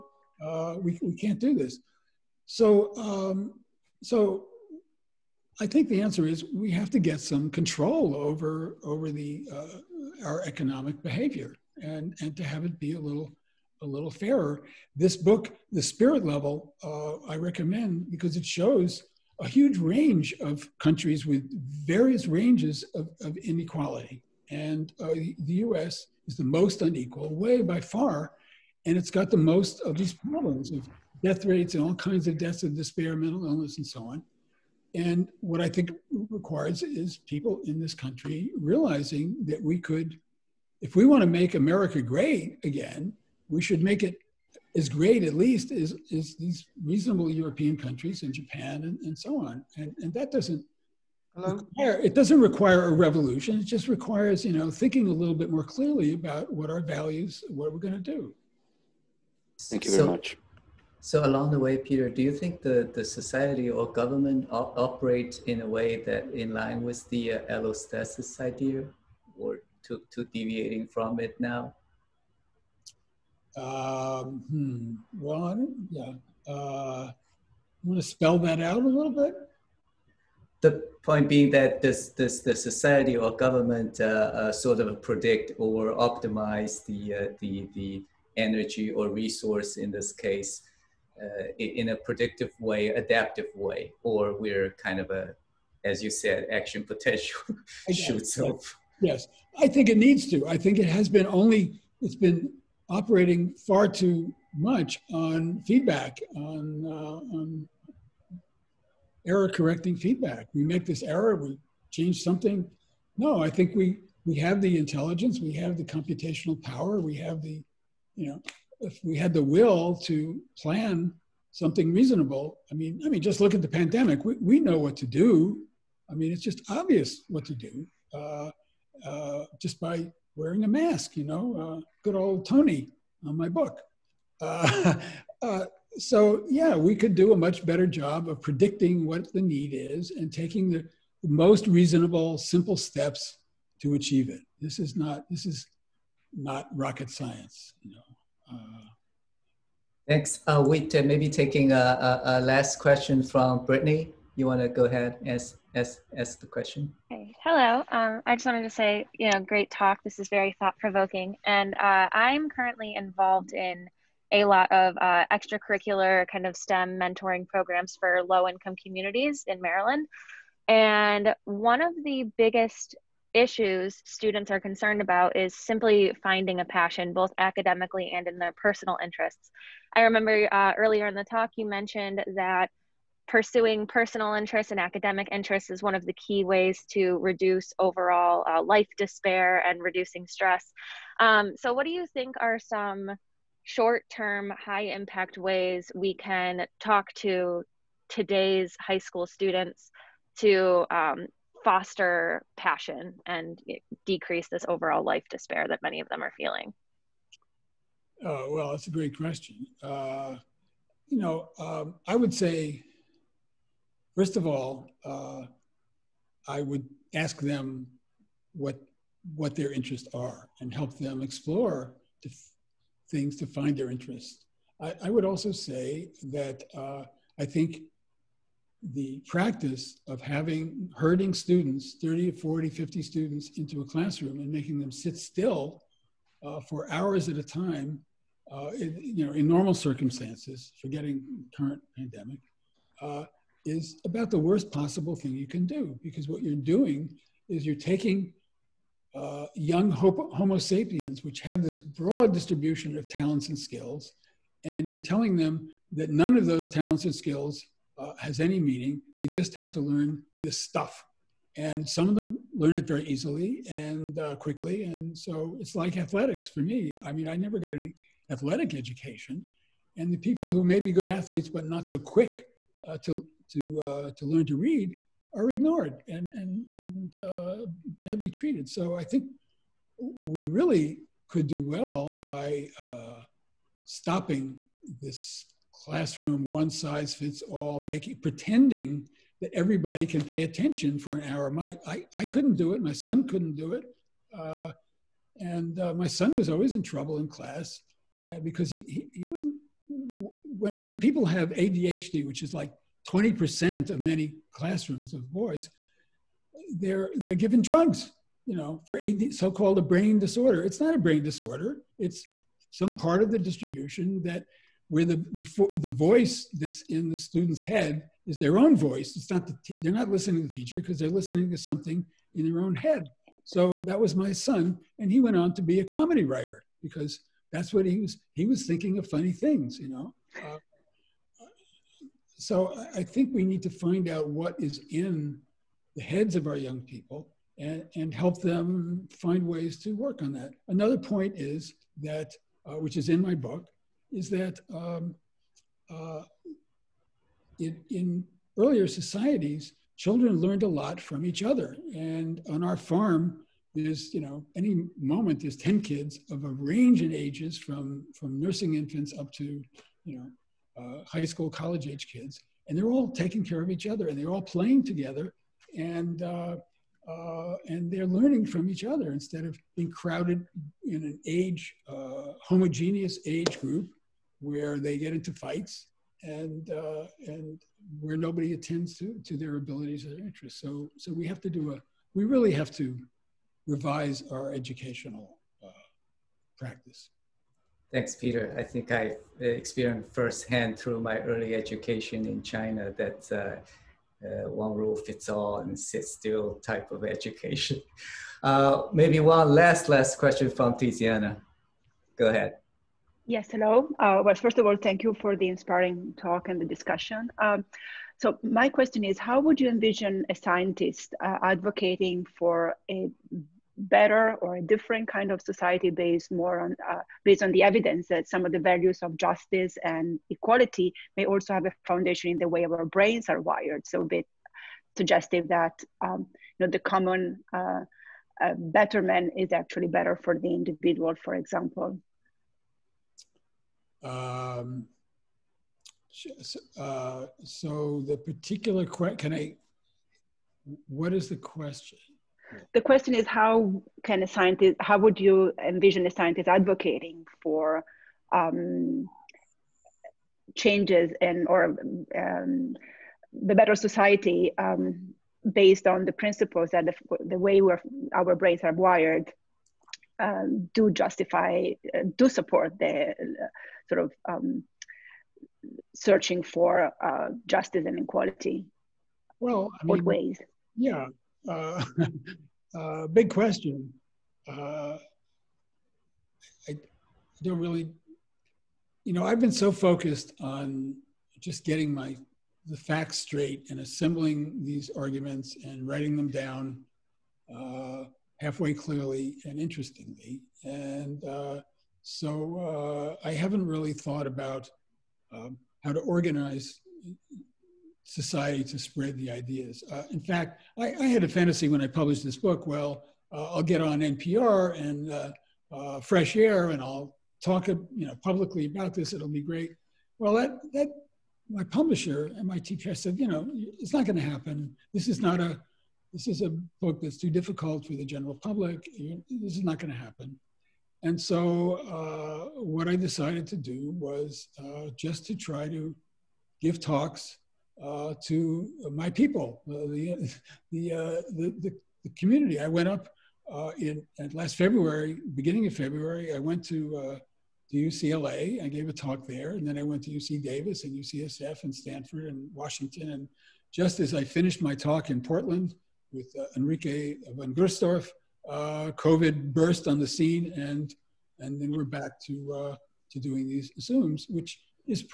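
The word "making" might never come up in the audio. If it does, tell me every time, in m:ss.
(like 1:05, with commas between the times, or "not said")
3:54, 4:47.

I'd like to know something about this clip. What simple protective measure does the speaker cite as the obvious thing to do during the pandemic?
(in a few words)
wearing a mask.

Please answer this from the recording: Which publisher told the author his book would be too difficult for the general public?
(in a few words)
MIT Press.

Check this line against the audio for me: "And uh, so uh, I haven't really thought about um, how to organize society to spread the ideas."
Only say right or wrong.
right.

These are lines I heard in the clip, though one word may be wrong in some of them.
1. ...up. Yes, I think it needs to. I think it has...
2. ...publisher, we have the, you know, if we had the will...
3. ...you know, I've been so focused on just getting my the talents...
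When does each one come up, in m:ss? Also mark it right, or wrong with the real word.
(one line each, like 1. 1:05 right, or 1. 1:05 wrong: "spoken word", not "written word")
1. 1:38 right
2. 1:56 wrong: "power", not "publisher"
3. 7:59 wrong: "facts", not "talents".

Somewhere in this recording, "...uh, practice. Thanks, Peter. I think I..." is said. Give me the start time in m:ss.
6:25.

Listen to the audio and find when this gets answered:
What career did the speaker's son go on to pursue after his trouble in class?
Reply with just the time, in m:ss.
5:25.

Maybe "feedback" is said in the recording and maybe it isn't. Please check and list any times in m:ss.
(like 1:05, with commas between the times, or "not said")
1:45, 1:49.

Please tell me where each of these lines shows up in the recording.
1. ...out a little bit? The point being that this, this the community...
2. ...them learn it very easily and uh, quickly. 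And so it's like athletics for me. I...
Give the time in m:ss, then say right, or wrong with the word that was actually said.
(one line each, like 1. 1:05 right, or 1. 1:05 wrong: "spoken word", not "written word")
1. 1:18 wrong: "society", not "community"
2. 4:22 right.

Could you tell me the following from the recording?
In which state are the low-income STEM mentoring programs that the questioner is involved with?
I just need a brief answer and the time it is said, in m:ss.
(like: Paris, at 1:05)
Maryland, at 2:49.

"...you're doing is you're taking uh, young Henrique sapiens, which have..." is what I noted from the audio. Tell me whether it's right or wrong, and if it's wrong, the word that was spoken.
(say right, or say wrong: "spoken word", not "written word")
wrong: "Homo", not "Henrique".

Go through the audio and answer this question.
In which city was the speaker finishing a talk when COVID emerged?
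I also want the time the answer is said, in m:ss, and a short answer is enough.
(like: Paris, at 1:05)
Portland, at 9:05.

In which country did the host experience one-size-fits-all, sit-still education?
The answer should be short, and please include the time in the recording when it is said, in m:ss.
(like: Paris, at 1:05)
China, at 6:32.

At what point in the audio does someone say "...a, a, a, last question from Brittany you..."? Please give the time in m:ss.
2:31.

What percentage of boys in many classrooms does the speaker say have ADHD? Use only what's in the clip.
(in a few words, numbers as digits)
20%.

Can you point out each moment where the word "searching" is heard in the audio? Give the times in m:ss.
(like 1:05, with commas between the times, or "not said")
7:45.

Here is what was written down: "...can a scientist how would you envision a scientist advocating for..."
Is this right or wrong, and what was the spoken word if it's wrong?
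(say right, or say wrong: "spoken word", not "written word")
right.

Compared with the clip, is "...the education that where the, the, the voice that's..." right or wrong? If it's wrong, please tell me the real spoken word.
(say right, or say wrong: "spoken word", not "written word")
wrong: "distribution", not "education".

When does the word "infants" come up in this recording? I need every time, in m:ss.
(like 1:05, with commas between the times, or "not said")
5:58.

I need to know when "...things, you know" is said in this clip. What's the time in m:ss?
5:29.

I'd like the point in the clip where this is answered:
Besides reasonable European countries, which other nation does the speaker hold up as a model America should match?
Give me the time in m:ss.
0:48.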